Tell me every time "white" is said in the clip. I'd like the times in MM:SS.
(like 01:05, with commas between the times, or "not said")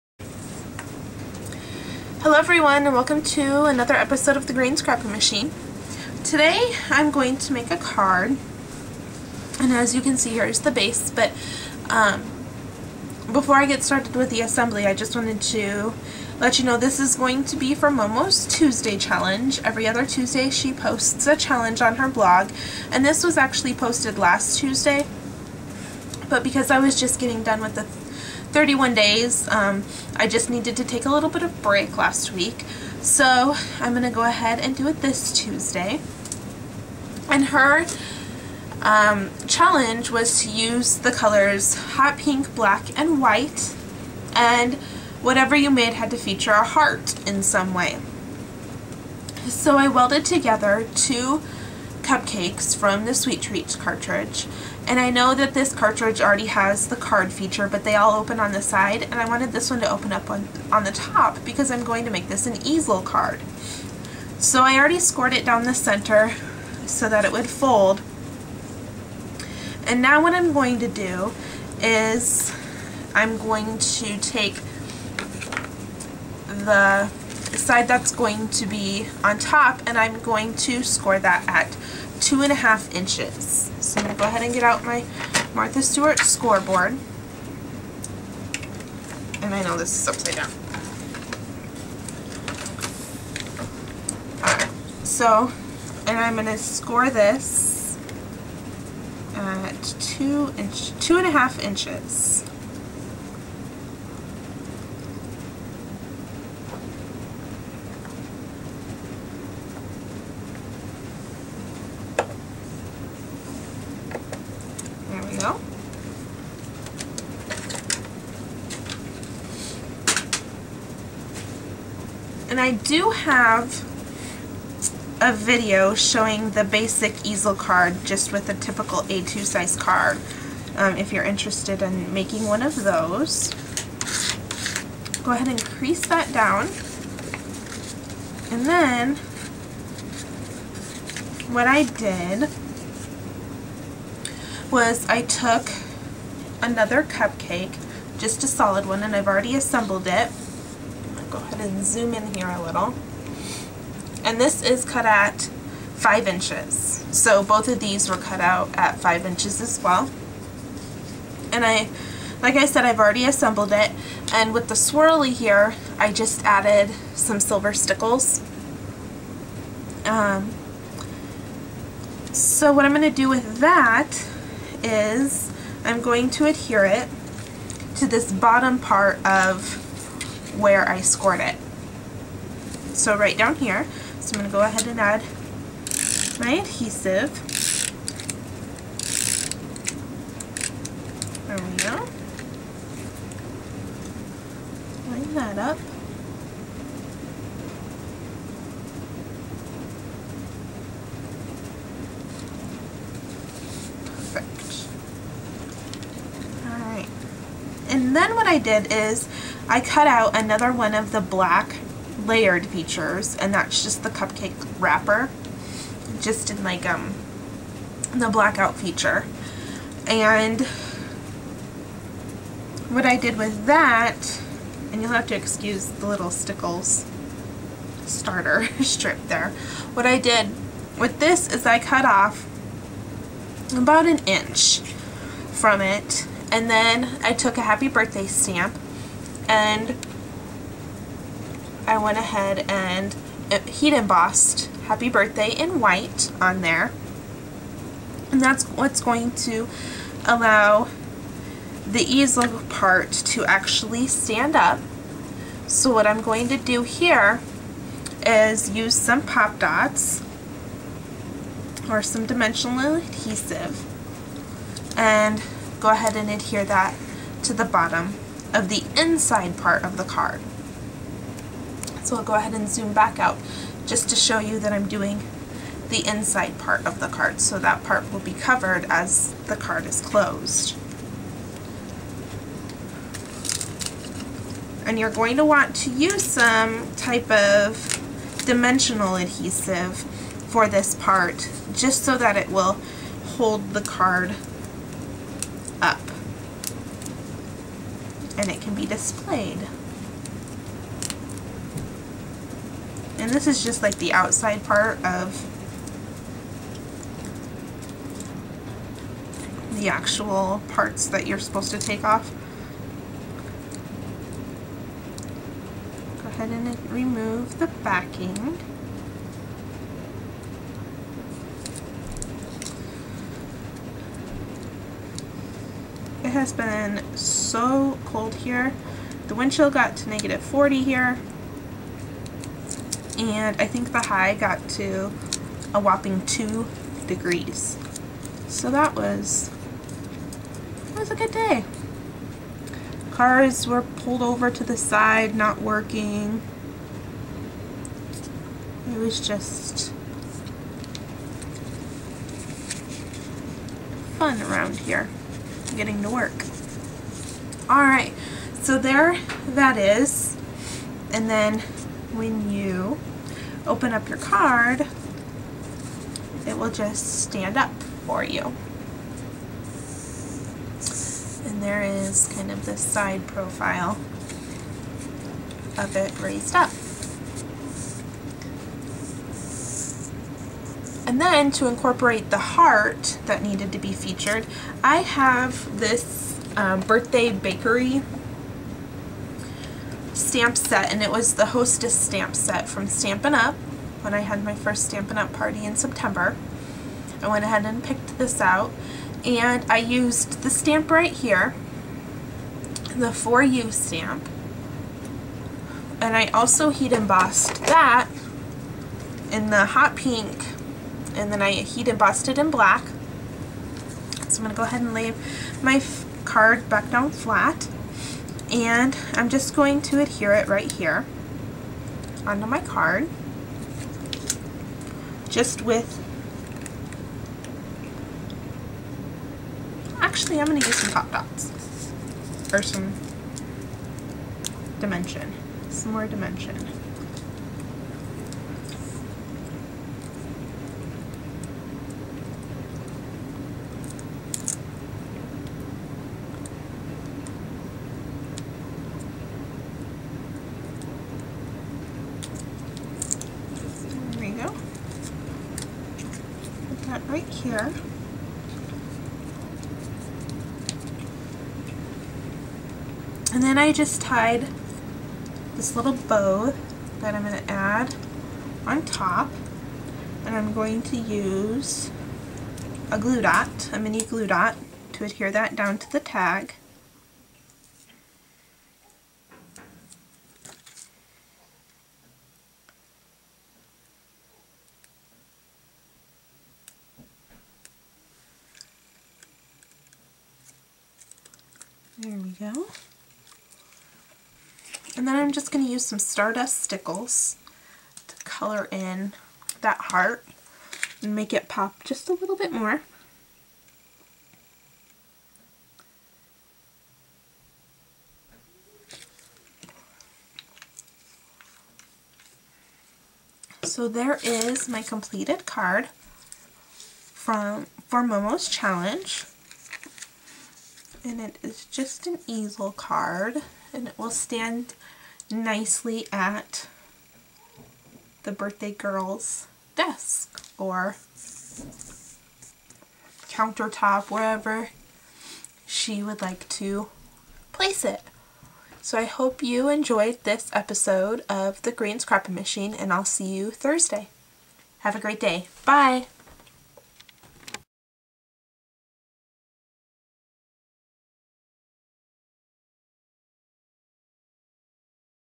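00:43, 04:05.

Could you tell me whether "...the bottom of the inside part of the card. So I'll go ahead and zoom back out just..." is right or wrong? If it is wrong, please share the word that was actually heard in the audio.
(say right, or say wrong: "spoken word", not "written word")
right.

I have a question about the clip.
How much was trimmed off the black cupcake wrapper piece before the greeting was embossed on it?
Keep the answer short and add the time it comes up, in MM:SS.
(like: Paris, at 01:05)
about an inch, at 03:53.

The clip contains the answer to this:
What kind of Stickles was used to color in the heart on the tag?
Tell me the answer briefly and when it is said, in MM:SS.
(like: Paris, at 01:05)
Stardust, at 08:15.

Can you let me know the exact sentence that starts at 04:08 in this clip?
And that's what's going to allow the easel part to actually stand up.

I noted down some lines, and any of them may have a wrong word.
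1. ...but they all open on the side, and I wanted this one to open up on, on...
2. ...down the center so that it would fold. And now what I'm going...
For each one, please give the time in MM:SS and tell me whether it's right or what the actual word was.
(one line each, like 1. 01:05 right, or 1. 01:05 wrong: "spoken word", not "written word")
1. 00:57 right
2. 01:05 right.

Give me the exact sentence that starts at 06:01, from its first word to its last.
And then when you open up your card, it will just stand up for you.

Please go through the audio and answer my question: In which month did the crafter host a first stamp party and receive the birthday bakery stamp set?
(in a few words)
September.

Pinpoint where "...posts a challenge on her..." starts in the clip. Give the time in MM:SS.
00:20.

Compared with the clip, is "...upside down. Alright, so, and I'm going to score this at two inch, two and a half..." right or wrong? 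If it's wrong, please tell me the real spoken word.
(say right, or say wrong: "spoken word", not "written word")
right.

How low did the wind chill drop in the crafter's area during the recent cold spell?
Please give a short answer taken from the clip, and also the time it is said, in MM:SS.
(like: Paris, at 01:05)
-40, at 05:30.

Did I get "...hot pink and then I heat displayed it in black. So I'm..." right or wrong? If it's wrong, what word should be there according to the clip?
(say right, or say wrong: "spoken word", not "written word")
wrong: "embossed", not "displayed".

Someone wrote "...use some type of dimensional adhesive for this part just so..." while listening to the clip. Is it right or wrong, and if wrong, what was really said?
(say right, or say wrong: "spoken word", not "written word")
right.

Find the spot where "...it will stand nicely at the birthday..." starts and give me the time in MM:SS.
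08:43.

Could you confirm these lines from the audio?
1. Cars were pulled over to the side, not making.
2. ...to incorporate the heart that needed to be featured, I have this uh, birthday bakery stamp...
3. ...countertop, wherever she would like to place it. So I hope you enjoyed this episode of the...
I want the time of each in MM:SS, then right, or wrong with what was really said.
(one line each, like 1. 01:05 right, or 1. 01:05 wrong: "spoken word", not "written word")
1. 05:43 wrong: "working", not "making"
2. 06:21 right
3. 08:53 right.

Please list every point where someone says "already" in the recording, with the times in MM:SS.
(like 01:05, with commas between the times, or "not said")
00:56, 01:04, 02:29, 02:42.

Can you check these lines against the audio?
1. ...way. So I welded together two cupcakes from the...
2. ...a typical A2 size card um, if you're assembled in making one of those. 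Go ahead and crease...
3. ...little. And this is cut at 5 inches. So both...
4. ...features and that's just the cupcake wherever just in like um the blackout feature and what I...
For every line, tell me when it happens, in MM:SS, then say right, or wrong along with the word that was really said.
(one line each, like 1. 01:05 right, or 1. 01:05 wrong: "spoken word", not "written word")
1. 00:47 right
2. 02:08 wrong: "interested", not "assembled"
3. 02:32 right
4. 03:32 wrong: "wrapper", not "wherever".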